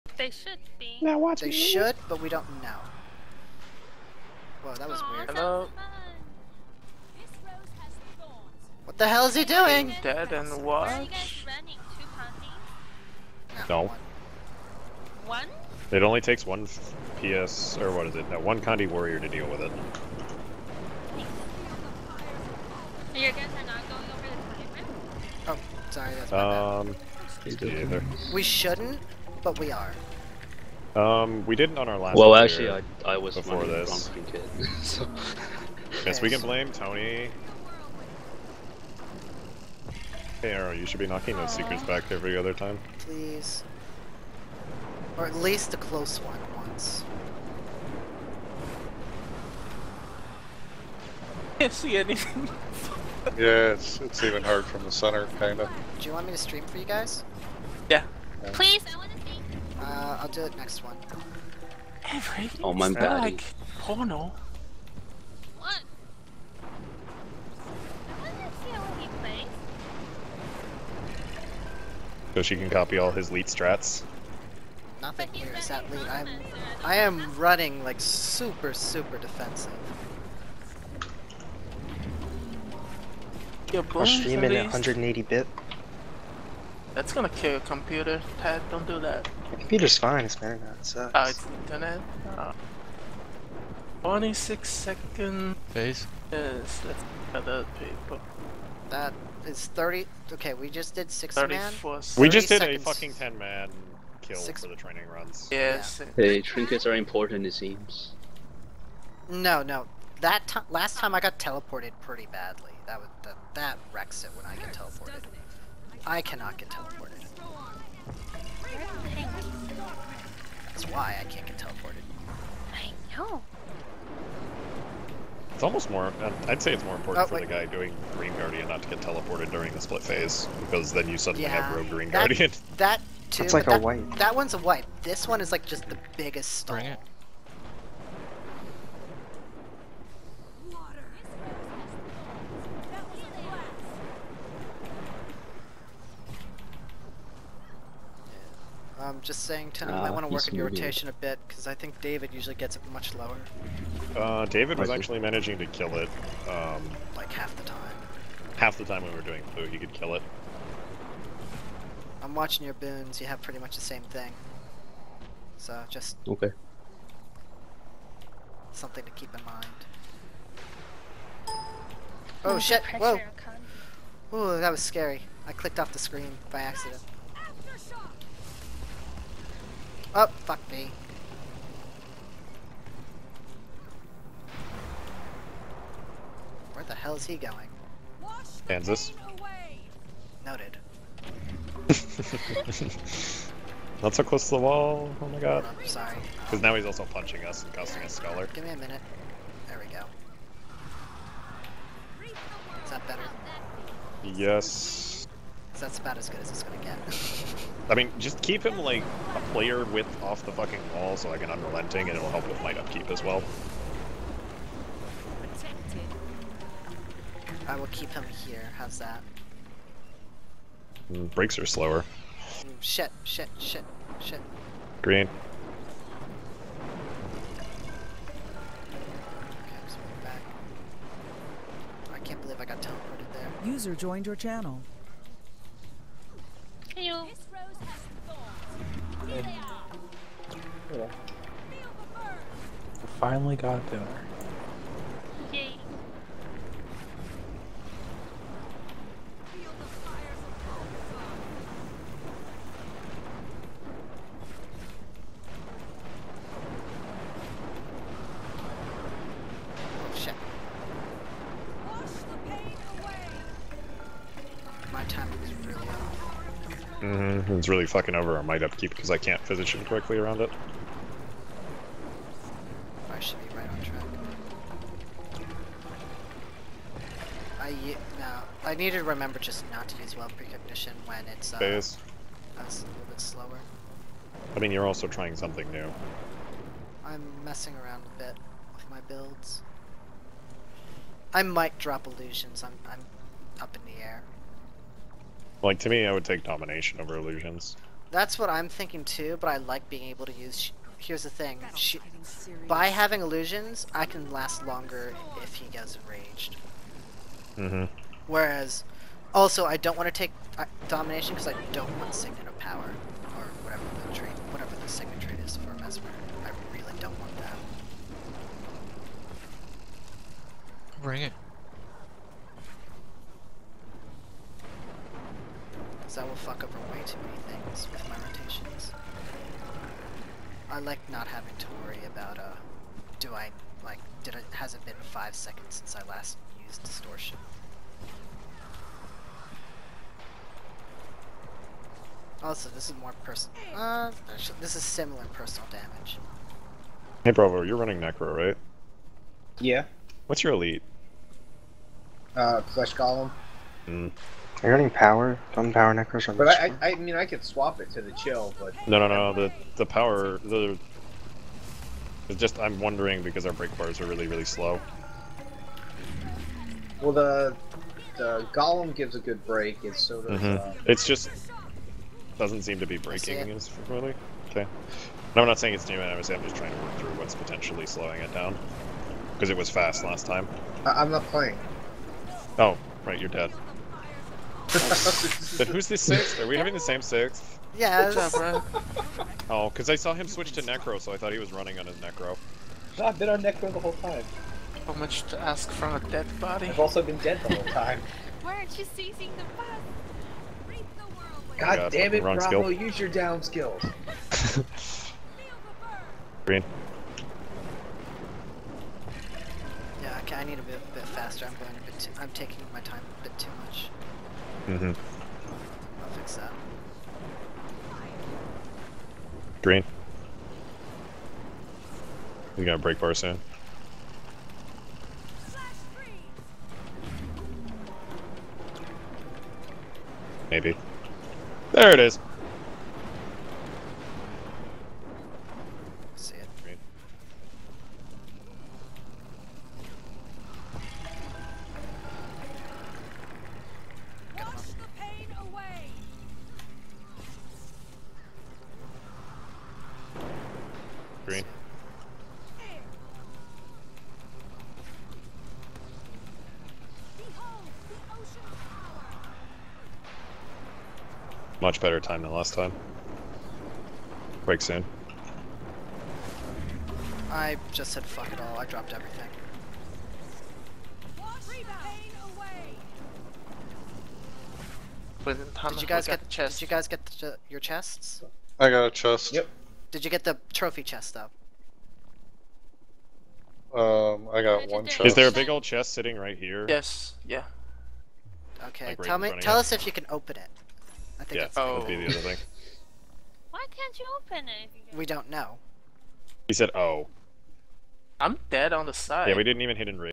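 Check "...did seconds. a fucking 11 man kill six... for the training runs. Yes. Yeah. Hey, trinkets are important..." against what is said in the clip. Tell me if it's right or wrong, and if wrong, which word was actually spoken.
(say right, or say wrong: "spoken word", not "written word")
wrong: "10", not "11".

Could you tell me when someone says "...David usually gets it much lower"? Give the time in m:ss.
2:32.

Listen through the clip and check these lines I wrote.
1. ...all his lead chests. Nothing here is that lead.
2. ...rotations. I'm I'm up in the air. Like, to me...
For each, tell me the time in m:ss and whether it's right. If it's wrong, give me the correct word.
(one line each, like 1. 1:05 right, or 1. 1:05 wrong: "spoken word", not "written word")
1. 1:12 wrong: "strats", not "chests"
2. 4:52 wrong: "illusions", not "rotations".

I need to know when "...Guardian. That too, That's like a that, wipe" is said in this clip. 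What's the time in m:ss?
2:12.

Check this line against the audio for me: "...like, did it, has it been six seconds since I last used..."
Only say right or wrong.
wrong.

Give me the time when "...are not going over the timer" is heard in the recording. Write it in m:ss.
0:23.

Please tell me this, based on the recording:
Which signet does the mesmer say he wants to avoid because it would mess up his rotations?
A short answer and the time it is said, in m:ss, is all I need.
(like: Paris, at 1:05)
Signet of Power, at 5:12.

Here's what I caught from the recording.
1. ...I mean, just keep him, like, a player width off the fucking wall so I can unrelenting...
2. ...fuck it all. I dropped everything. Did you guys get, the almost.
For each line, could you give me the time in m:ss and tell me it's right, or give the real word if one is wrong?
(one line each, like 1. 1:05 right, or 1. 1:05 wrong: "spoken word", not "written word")
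1. 3:27 right
2. 7:48 wrong: "chest", not "almost".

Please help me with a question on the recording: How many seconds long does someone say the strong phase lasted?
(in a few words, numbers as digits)
26.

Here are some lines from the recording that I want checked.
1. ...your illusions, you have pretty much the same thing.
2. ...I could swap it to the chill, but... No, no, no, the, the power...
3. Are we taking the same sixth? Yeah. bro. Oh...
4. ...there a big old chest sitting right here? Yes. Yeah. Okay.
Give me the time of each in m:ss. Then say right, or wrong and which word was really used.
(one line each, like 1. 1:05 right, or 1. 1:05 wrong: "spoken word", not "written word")
1. 2:42 wrong: "boons", not "illusions"
2. 5:57 right
3. 6:26 wrong: "having", not "taking"
4. 8:05 right.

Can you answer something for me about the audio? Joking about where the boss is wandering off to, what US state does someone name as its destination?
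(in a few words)
Kansas.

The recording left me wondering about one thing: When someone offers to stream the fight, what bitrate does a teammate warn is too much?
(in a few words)
180.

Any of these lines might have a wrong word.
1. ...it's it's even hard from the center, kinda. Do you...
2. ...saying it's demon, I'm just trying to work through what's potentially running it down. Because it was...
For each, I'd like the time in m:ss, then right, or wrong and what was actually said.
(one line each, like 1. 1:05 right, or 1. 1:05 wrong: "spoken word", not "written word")
1. 0:53 right
2. 6:15 wrong: "slowing", not "running".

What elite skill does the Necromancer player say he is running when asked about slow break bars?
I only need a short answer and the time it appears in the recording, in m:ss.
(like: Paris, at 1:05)
Flesh Golem, at 5:52.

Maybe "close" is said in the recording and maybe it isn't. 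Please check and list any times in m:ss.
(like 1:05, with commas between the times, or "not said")
0:45, 3:14.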